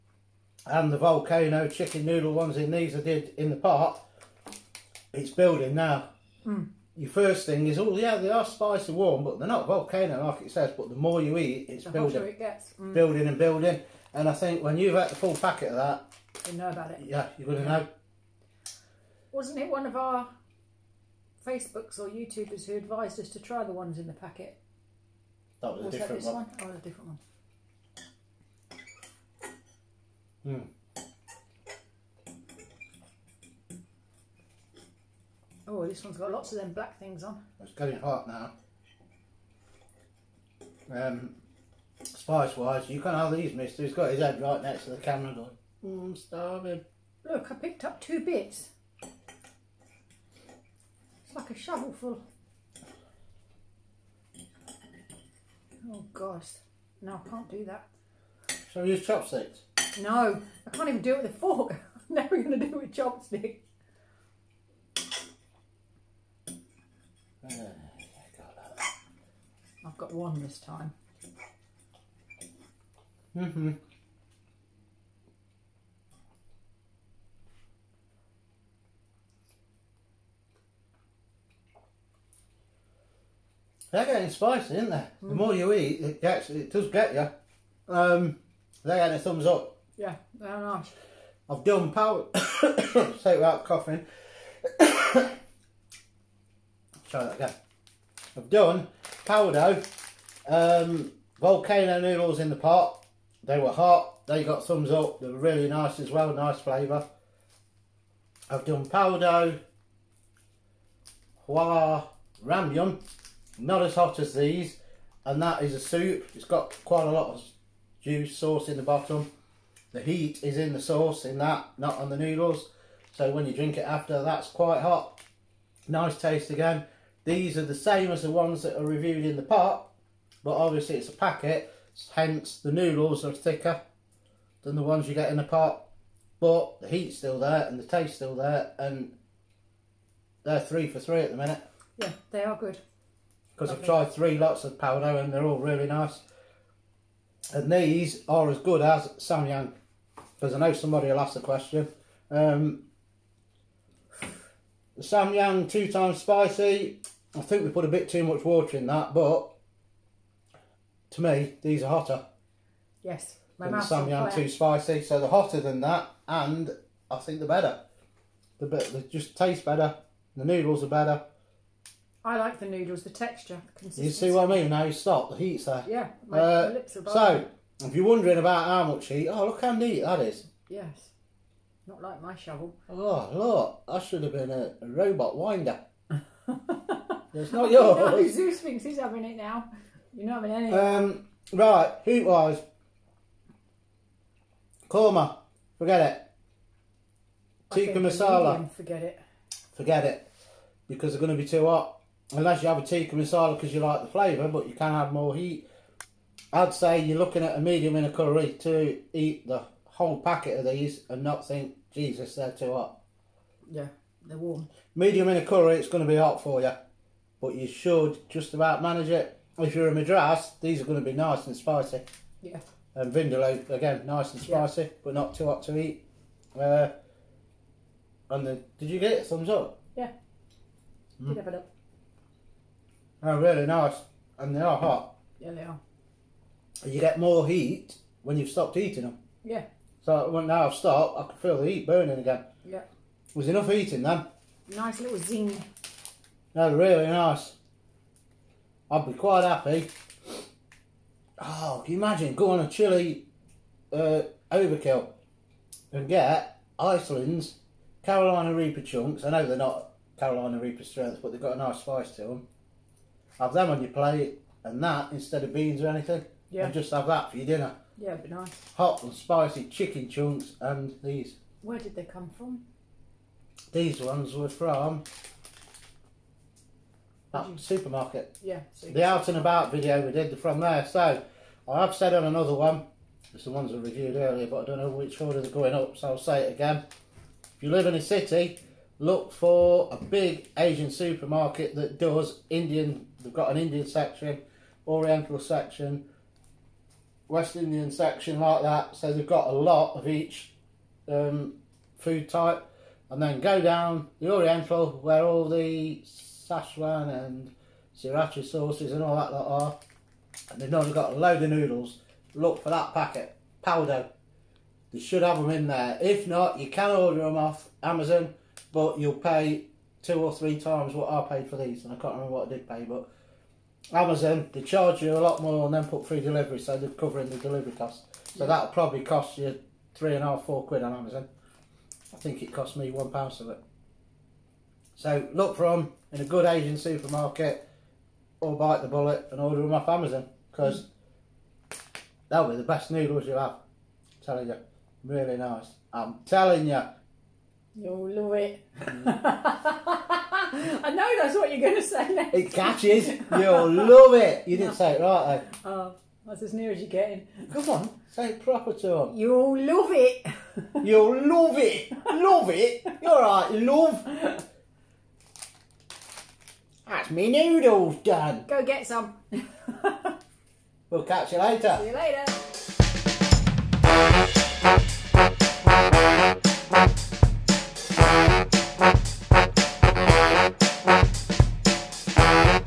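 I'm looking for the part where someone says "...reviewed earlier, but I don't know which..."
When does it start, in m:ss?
4:43.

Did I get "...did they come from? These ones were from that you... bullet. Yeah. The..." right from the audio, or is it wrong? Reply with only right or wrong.
wrong.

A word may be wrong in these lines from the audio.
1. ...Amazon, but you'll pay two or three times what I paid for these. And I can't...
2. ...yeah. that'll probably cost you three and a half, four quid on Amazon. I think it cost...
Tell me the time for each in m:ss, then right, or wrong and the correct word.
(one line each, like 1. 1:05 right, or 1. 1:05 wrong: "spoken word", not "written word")
1. 5:17 right
2. 5:28 right.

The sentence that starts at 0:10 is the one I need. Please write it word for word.
But the more you eat, it's the building, it gets.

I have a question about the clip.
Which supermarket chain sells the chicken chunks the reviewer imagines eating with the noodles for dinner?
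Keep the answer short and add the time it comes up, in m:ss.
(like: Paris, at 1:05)
Iceland, at 4:16.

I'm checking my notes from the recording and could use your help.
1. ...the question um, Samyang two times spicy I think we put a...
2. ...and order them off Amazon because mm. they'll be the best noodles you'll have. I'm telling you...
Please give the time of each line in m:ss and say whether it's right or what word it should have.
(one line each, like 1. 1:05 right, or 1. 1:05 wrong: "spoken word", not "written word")
1. 2:31 right
2. 5:39 right.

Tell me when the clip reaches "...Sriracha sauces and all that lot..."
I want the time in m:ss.
5:08.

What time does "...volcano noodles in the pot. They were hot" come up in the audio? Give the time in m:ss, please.
1:41.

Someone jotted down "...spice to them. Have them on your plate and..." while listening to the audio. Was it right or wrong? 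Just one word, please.
right.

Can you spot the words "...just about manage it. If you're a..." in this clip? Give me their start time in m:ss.
3:38.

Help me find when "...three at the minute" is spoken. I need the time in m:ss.
2:20.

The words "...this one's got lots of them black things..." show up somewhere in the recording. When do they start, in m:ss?
0:35.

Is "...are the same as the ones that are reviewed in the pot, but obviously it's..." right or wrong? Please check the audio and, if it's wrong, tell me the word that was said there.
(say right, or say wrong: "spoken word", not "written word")
right.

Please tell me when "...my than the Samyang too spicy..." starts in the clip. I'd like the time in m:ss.
2:43.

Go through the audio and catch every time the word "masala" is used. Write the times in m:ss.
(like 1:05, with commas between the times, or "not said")
3:17, 3:23.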